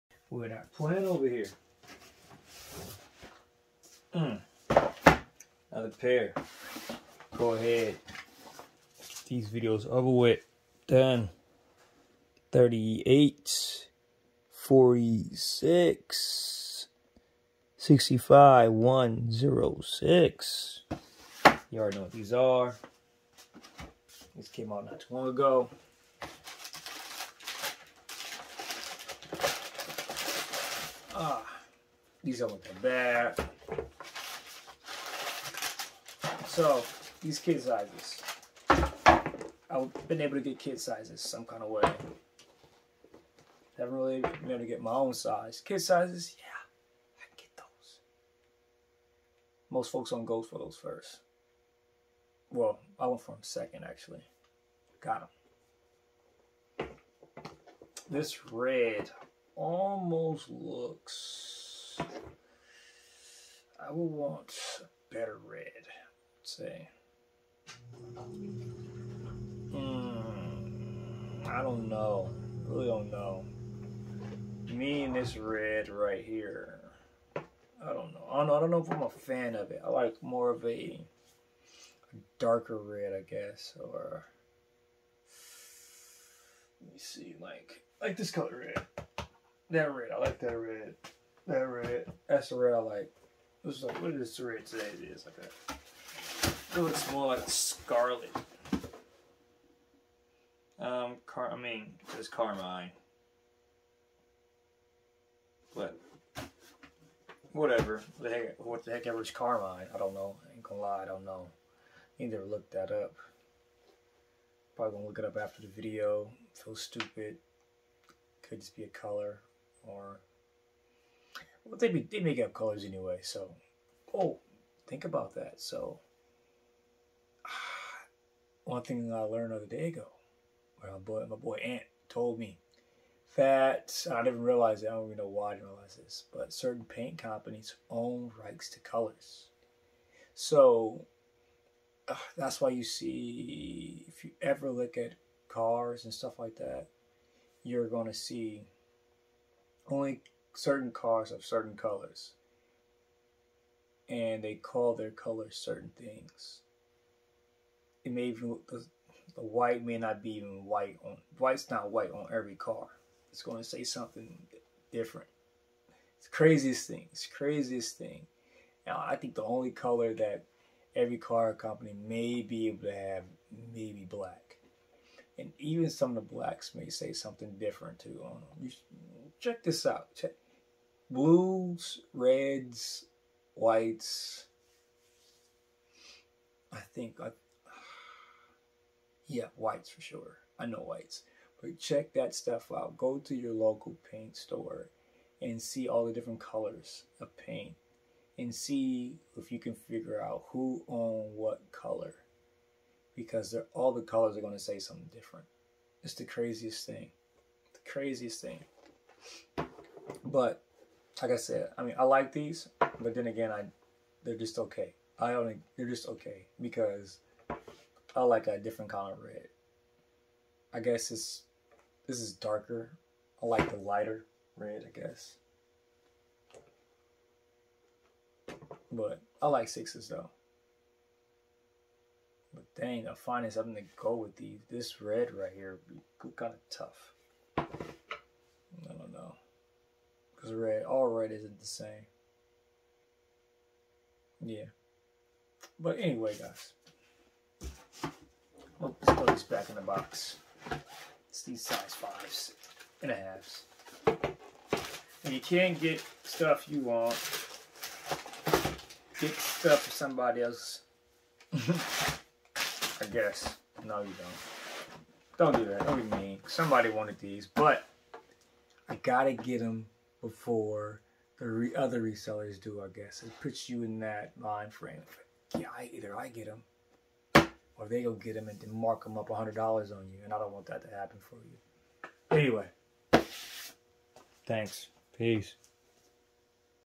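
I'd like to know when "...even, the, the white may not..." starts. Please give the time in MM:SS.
02:38.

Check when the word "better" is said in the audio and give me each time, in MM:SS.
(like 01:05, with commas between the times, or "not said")
01:05.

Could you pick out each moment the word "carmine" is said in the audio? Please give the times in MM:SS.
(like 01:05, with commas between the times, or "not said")
01:42, 01:49.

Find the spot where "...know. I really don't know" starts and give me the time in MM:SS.
01:11.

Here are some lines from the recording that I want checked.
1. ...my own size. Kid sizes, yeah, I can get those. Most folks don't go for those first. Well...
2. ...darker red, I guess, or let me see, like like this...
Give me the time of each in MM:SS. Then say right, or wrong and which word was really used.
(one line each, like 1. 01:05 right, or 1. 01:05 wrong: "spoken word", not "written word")
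1. 00:44 right
2. 01:22 right.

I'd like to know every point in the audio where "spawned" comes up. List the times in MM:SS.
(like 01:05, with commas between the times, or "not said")
not said.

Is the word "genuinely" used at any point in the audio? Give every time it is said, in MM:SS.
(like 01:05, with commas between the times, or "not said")
not said.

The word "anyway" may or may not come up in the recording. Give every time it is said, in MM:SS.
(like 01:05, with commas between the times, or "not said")
02:02, 04:05, 04:42.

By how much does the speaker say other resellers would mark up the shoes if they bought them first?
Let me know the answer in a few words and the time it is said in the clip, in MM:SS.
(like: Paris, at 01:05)
$100, at 04:39.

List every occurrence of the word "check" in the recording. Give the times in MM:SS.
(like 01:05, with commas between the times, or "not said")
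02:59, 03:11.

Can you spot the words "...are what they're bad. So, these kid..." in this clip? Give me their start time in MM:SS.
00:32.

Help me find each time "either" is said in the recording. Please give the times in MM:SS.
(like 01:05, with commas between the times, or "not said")
04:35.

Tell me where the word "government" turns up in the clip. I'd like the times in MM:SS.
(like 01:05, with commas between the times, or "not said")
not said.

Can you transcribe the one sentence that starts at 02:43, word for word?
It's going to say something different.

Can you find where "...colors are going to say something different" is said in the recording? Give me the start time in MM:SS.
03:24.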